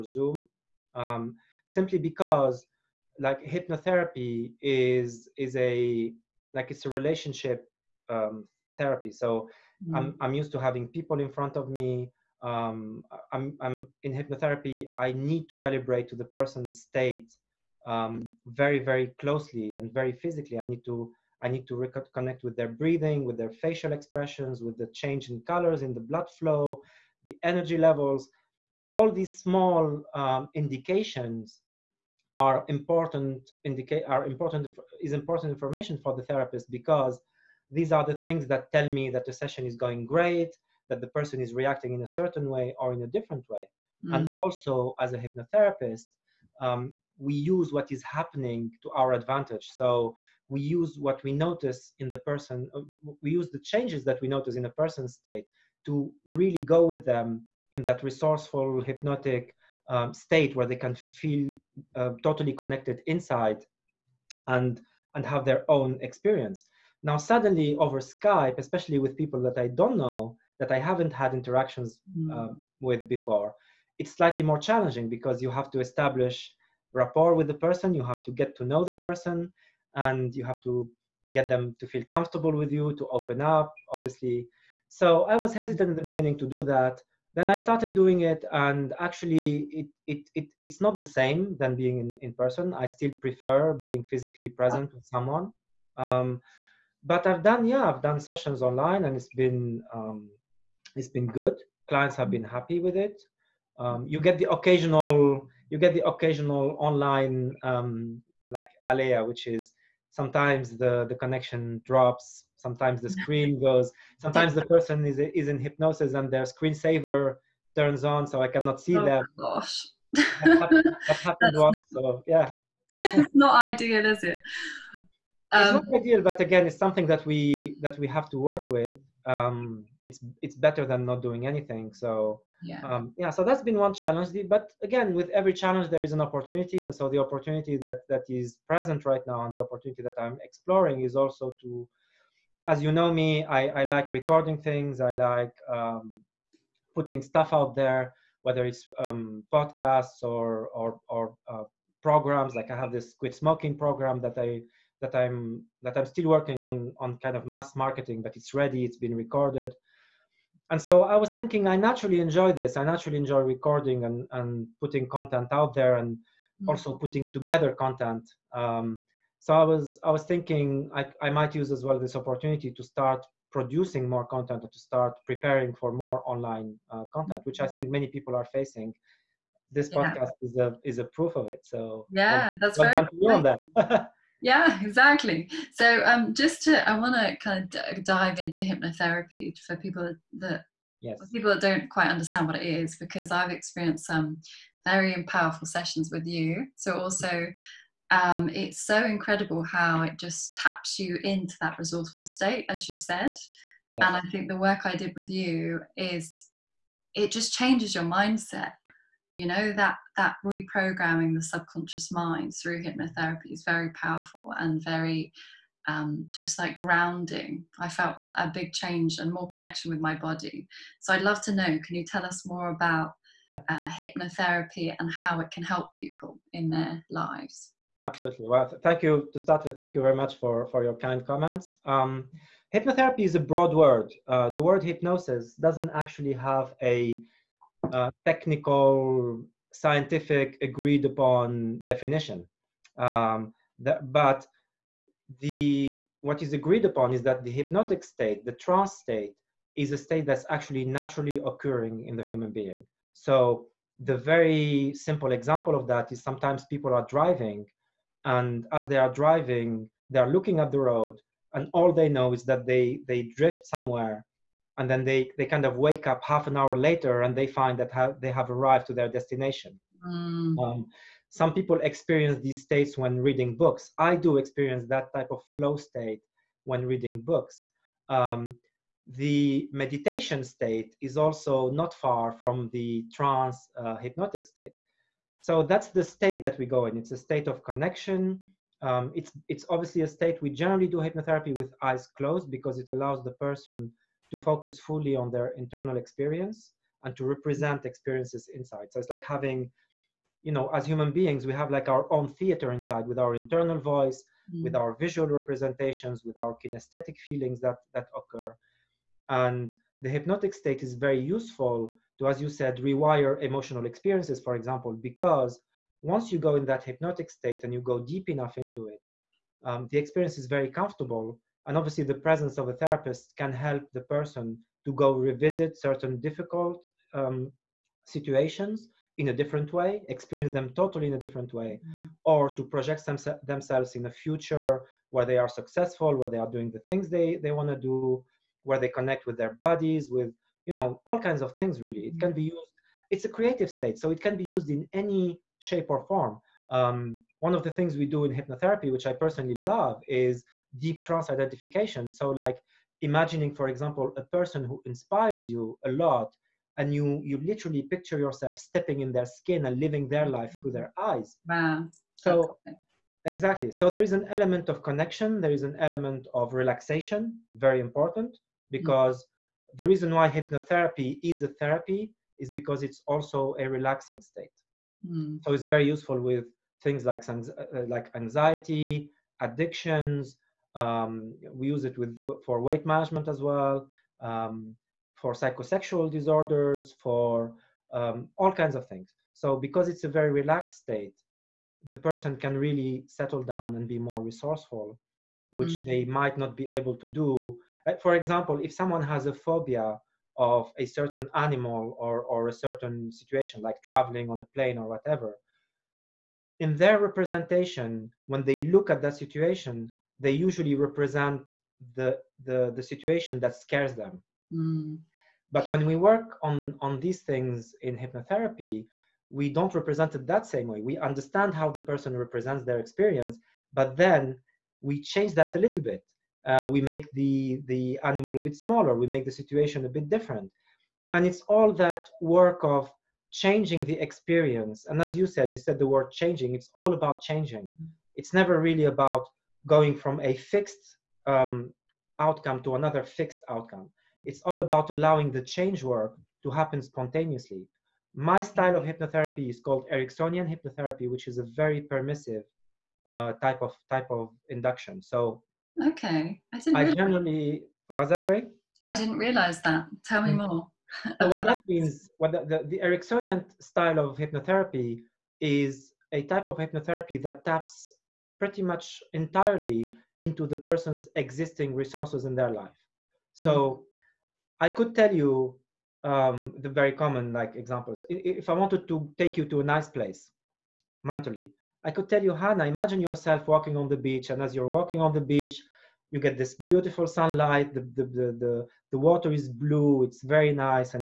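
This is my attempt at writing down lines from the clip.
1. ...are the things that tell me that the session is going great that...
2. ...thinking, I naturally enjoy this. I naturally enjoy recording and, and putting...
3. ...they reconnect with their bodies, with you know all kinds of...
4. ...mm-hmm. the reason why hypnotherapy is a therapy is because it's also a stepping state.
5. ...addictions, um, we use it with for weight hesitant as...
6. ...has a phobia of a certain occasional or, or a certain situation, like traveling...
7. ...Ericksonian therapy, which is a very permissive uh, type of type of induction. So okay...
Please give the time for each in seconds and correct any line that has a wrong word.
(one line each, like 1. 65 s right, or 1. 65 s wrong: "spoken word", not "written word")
1. 37 s right
2. 161 s right
3. 338 s wrong: "connect", not "reconnect"
4. 369 s wrong: "relaxing", not "stepping"
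5. 379 s wrong: "management", not "hesitant"
6. 399 s wrong: "animal", not "occasional"
7. 449 s wrong: "hypnotherapy", not "therapy".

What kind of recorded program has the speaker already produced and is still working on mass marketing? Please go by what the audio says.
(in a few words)
quit smoking program.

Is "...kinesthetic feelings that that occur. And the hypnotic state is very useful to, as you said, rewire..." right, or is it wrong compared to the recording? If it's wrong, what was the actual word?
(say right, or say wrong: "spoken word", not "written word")
right.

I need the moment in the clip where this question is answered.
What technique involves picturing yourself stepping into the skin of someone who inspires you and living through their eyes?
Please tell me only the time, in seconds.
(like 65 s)
350 s.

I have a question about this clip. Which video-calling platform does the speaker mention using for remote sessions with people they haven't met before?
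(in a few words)
Skype.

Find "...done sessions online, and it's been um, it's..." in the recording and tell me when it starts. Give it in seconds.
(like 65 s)
98 s.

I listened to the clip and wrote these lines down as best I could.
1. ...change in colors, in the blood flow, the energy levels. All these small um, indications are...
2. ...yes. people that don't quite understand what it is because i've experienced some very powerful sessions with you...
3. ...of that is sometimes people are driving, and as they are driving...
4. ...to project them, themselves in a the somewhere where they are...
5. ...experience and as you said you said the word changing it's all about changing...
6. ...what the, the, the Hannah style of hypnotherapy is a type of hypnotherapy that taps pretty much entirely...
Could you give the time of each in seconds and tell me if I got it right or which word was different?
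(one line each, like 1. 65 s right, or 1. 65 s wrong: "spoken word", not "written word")
1. 24 s right
2. 191 s right
3. 255 s right
4. 332 s wrong: "future", not "somewhere"
5. 434 s right
6. 462 s wrong: "Ericksonian", not "Hannah".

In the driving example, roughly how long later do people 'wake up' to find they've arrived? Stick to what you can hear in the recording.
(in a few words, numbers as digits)
half an hour.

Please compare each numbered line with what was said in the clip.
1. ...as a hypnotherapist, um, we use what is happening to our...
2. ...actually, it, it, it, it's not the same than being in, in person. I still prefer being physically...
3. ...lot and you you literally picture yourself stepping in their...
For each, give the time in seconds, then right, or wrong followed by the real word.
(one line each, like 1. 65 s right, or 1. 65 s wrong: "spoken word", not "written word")
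1. 44 s right
2. 88 s right
3. 355 s right.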